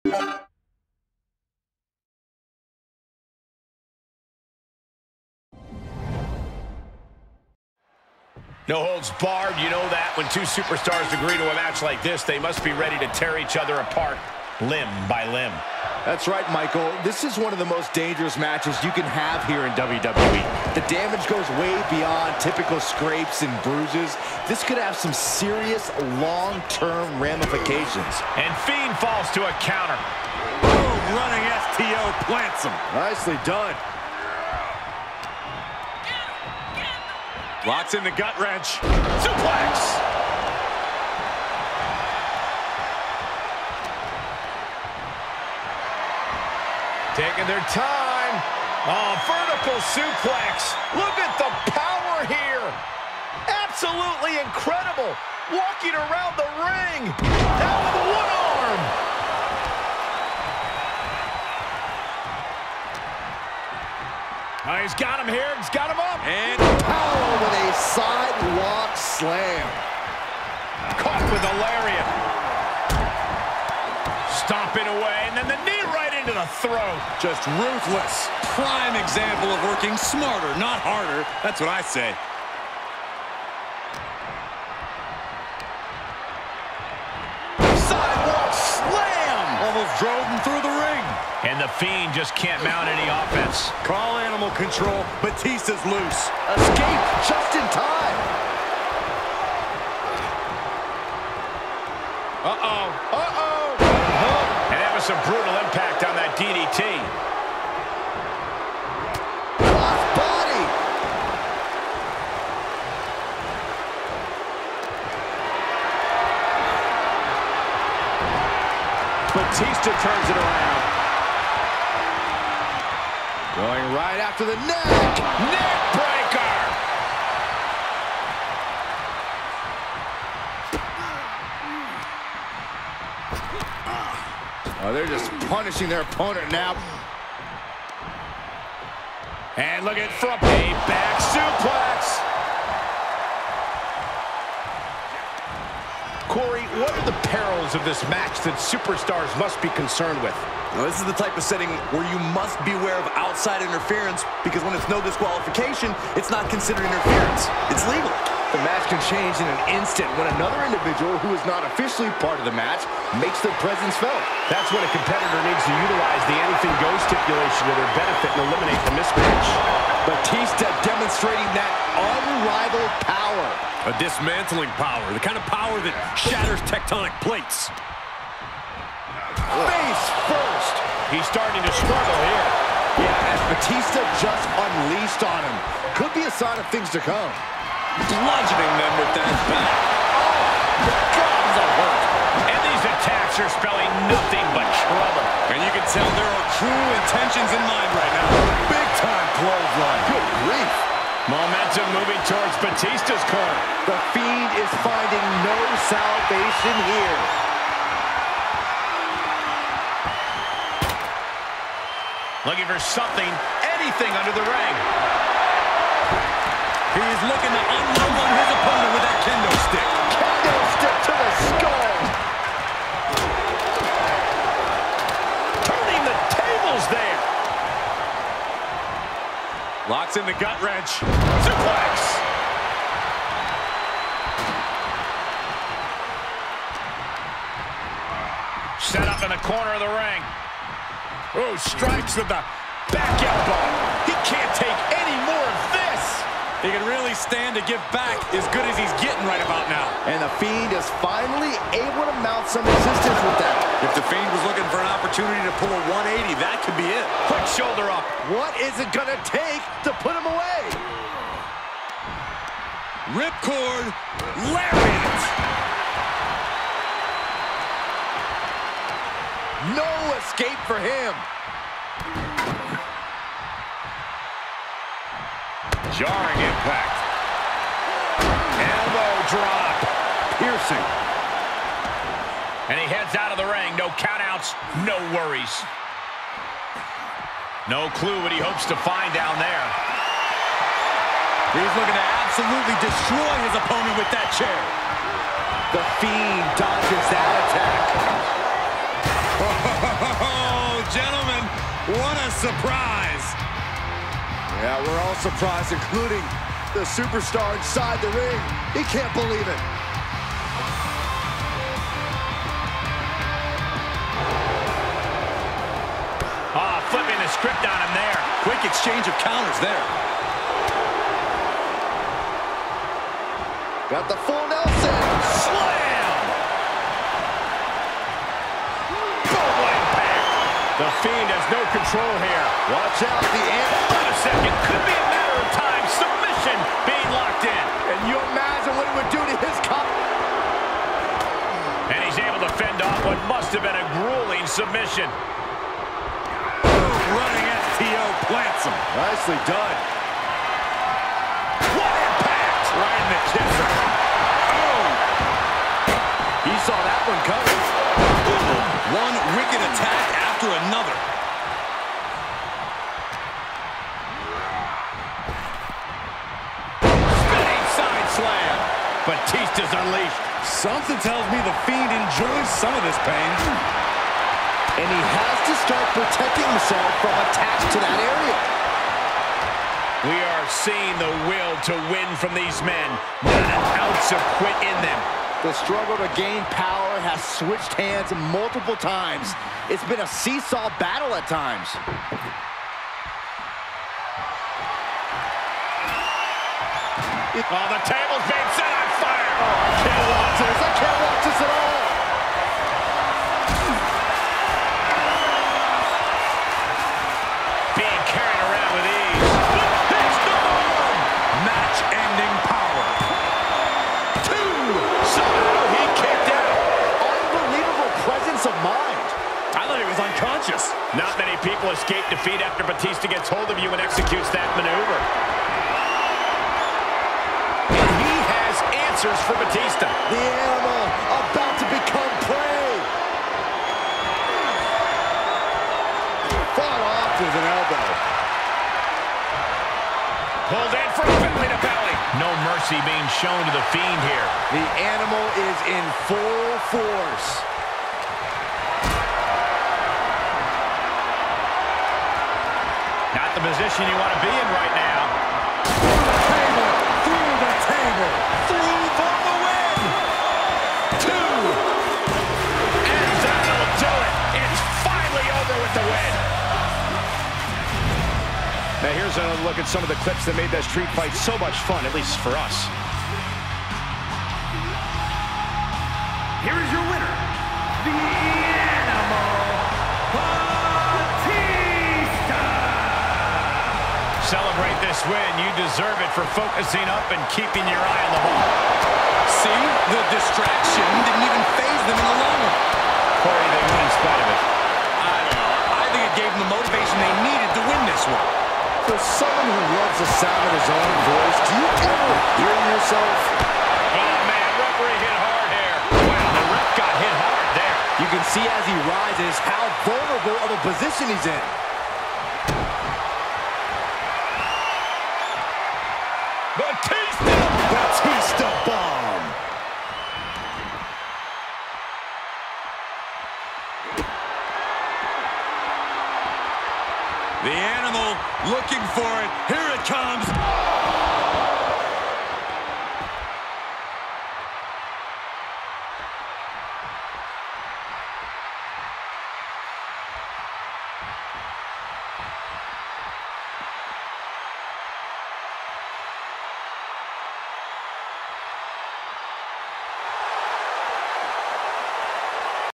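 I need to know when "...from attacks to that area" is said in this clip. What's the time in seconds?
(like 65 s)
377 s.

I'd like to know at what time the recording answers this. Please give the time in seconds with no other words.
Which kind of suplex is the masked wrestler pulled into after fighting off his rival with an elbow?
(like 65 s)
441 s.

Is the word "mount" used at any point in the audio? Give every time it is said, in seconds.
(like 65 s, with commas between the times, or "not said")
92 s, 252 s.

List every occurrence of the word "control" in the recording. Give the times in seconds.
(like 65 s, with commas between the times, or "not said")
94 s, 331 s.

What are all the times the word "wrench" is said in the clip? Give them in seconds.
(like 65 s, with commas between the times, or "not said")
38 s, 230 s.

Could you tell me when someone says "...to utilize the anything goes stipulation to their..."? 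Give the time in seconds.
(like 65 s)
165 s.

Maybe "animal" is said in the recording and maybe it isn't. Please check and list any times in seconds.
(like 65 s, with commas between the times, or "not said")
94 s, 430 s, 444 s.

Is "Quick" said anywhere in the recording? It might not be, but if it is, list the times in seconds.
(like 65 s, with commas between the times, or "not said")
257 s, 318 s.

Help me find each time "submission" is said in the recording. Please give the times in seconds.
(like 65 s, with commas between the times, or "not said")
335 s, 344 s.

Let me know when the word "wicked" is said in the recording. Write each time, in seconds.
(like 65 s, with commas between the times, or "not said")
359 s.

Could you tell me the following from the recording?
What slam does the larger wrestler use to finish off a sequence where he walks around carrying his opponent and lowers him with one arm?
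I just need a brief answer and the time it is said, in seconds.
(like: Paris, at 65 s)
sidewalk slam, at 67 s.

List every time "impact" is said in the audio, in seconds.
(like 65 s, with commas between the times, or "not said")
105 s, 276 s, 351 s.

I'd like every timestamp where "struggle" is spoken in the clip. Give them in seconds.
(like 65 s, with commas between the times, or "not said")
181 s, 385 s.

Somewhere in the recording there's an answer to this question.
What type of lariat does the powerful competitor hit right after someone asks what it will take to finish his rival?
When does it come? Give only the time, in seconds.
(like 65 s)
263 s.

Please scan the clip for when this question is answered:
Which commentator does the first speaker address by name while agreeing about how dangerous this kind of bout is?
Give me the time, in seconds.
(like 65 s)
16 s.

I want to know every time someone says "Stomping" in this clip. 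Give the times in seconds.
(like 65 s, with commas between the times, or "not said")
74 s.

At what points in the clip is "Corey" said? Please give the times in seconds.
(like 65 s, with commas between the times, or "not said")
146 s, 493 s.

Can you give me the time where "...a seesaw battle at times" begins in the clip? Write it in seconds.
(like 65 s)
390 s.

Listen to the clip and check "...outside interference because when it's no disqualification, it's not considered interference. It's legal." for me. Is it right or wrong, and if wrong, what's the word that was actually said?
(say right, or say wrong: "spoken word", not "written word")
right.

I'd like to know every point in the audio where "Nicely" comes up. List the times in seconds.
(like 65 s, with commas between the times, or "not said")
32 s, 348 s.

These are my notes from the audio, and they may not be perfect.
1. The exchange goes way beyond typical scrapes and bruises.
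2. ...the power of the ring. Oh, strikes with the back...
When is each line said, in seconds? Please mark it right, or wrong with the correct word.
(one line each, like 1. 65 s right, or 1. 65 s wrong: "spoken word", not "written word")
1. 20 s wrong: "damage", not "exchange"
2. 239 s wrong: "corner", not "power".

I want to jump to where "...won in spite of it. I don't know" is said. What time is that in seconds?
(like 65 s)
493 s.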